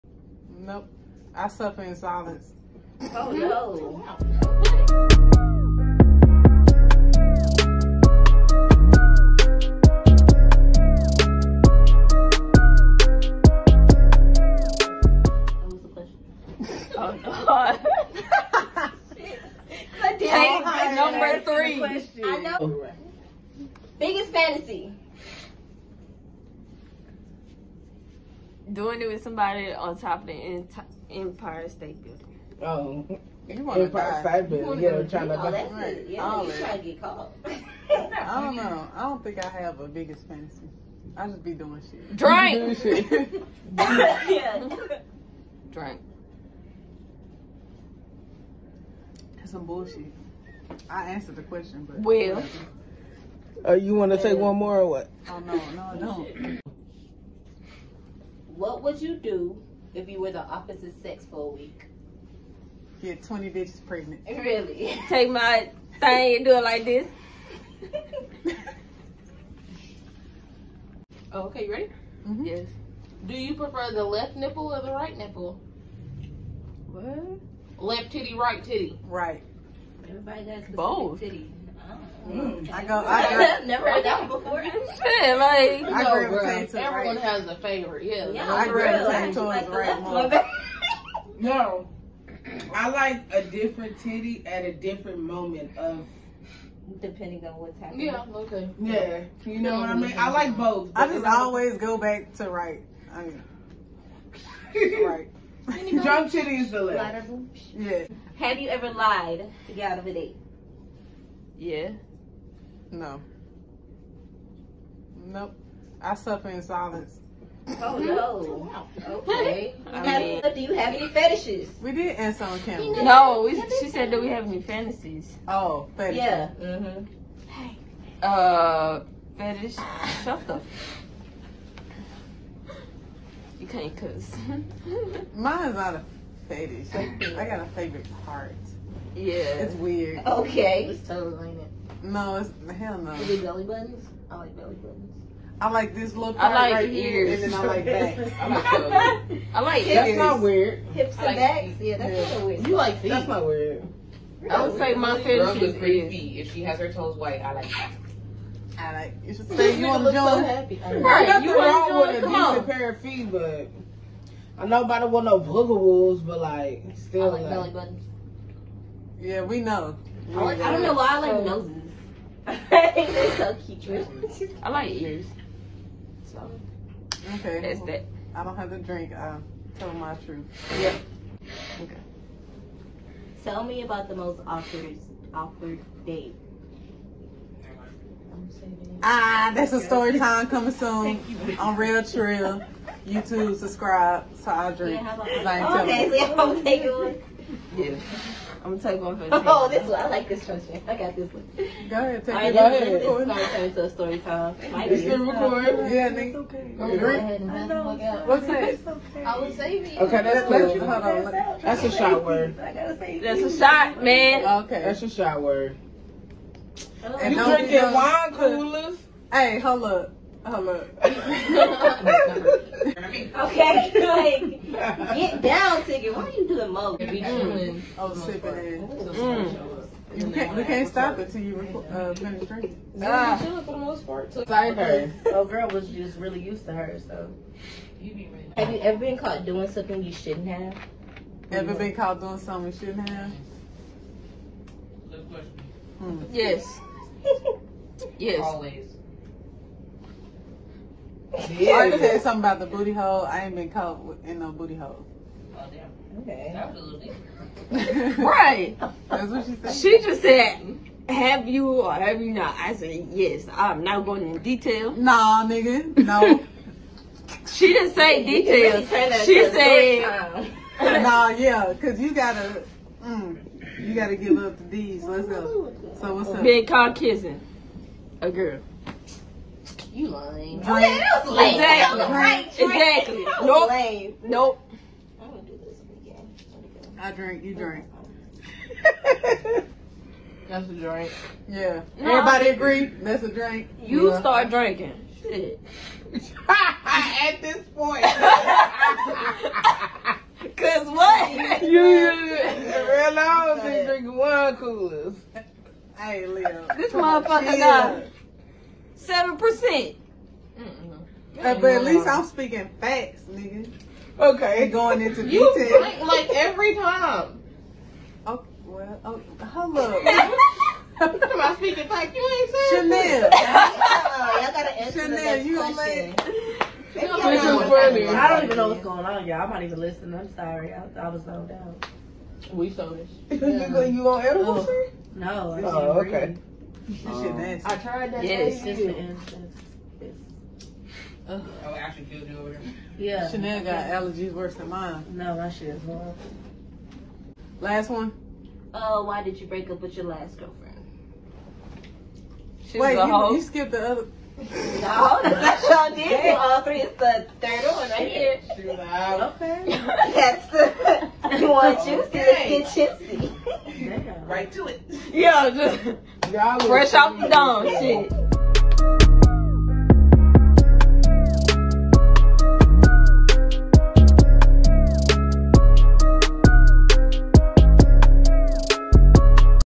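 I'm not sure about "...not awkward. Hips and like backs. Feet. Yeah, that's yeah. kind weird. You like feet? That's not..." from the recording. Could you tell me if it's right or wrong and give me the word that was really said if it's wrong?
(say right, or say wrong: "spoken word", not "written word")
wrong: "weird", not "awkward".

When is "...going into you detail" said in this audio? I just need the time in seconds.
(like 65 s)
314 s.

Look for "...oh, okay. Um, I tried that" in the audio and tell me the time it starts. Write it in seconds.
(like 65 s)
335 s.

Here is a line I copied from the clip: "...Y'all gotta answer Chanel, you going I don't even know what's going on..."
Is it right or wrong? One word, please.
right.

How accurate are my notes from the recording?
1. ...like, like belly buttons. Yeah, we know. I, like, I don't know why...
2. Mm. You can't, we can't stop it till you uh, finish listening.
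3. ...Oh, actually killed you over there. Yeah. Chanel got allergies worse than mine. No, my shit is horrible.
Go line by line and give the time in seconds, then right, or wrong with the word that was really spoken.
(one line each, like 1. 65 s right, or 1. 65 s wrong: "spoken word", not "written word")
1. 167 s right
2. 229 s wrong: "drinking", not "listening"
3. 341 s right.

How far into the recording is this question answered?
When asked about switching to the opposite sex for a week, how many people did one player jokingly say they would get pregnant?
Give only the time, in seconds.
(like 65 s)
63 s.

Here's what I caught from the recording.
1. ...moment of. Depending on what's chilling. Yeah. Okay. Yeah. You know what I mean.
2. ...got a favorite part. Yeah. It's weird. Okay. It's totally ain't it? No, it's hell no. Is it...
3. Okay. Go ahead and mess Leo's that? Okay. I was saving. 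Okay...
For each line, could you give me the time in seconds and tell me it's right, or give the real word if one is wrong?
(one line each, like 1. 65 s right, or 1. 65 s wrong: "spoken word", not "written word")
1. 95 s wrong: "happening", not "chilling"
2. 137 s right
3. 206 s wrong: "What", not "Leo".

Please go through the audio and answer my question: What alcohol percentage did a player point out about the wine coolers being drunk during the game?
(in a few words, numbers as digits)
7%.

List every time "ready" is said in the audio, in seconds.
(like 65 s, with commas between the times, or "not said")
71 s, 238 s.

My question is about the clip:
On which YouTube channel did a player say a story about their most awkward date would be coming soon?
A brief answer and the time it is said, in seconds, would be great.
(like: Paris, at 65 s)
Relle Trill, at 191 s.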